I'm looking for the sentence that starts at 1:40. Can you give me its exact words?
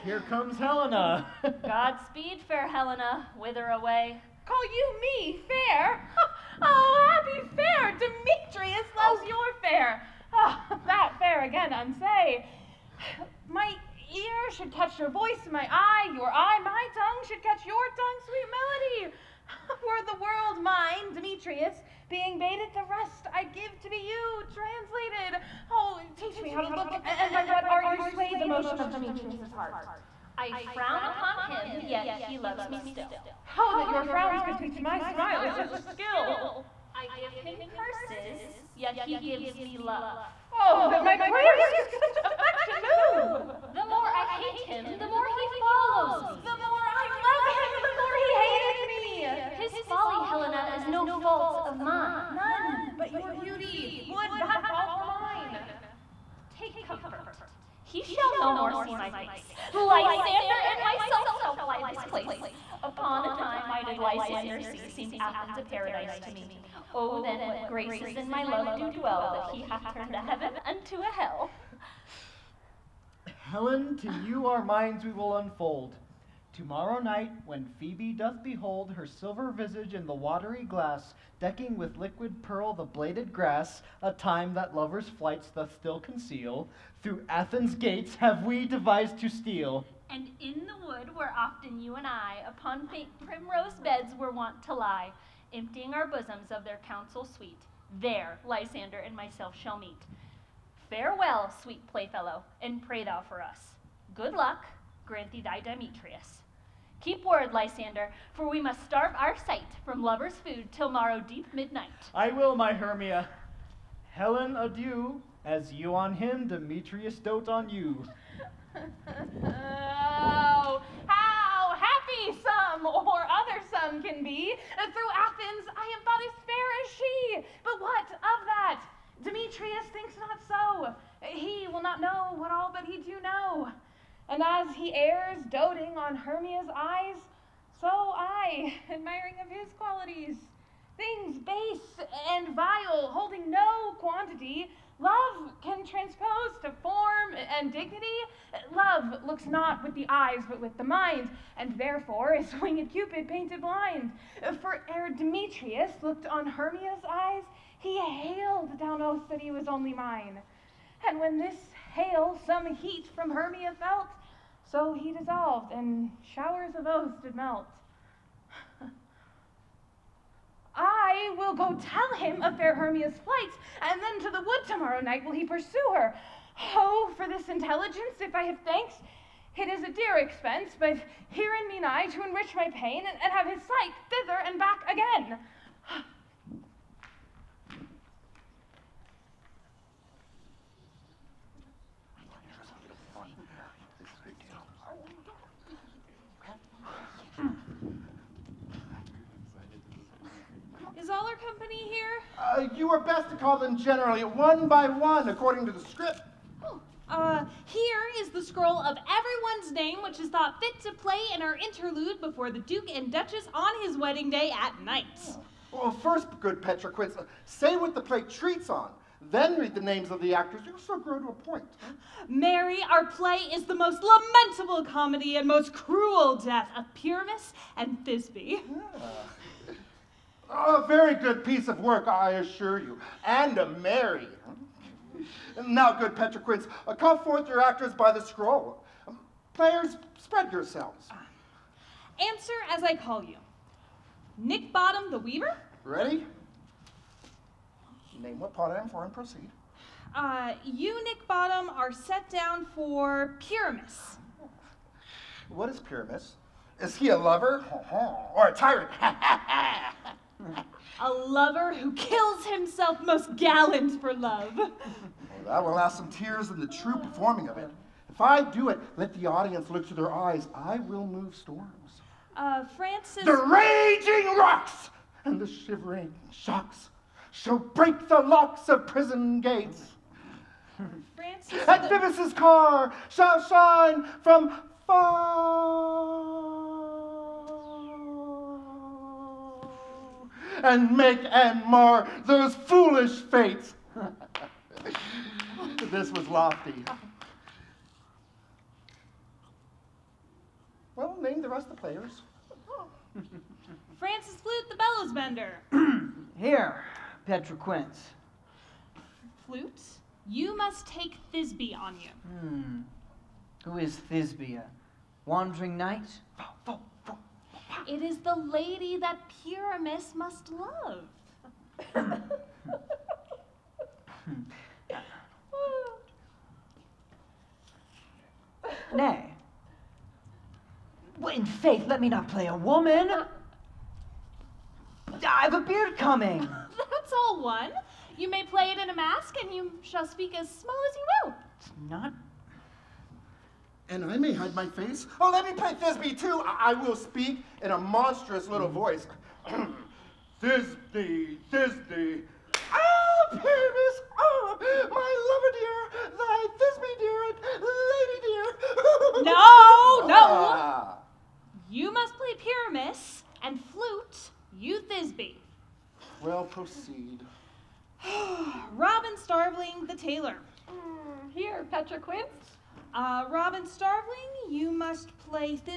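Farewell, sweet playfellow, and pray thou for us.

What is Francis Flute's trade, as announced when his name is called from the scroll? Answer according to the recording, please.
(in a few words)
bellows bender.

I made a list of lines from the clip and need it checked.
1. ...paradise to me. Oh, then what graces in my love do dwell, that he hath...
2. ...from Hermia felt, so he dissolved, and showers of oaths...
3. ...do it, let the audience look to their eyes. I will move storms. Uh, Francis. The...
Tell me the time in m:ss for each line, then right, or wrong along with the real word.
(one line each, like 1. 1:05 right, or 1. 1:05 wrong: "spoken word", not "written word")
1. 1:05 right
2. 2:43 right
3. 4:28 right.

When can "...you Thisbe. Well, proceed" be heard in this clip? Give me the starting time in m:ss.
6:04.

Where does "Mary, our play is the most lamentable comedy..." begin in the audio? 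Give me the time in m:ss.
3:42.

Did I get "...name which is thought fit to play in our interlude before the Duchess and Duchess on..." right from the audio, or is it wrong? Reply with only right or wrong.
wrong.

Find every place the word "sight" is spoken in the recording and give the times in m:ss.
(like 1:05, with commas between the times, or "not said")
1:49, 3:03.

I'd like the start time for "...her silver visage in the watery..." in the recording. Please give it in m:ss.
1:18.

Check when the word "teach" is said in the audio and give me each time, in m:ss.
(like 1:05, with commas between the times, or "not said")
0:26, 0:34.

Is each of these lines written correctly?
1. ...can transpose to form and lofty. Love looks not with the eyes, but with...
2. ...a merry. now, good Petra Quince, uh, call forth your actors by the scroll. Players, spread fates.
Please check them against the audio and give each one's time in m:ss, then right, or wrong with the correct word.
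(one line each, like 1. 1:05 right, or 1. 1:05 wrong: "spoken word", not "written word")
1. 2:25 wrong: "dignity", not "lofty"
2. 3:53 wrong: "yourselves", not "fates".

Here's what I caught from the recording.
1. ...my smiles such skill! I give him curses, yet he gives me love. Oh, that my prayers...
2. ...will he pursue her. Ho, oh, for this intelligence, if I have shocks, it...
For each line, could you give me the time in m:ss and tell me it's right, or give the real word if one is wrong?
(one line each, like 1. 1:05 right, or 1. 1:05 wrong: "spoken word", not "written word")
1. 0:34 right
2. 2:55 wrong: "thanks", not "shocks".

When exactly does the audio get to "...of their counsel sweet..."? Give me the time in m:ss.
1:36.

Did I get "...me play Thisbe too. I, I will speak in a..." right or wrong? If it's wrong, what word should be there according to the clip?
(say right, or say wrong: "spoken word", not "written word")
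right.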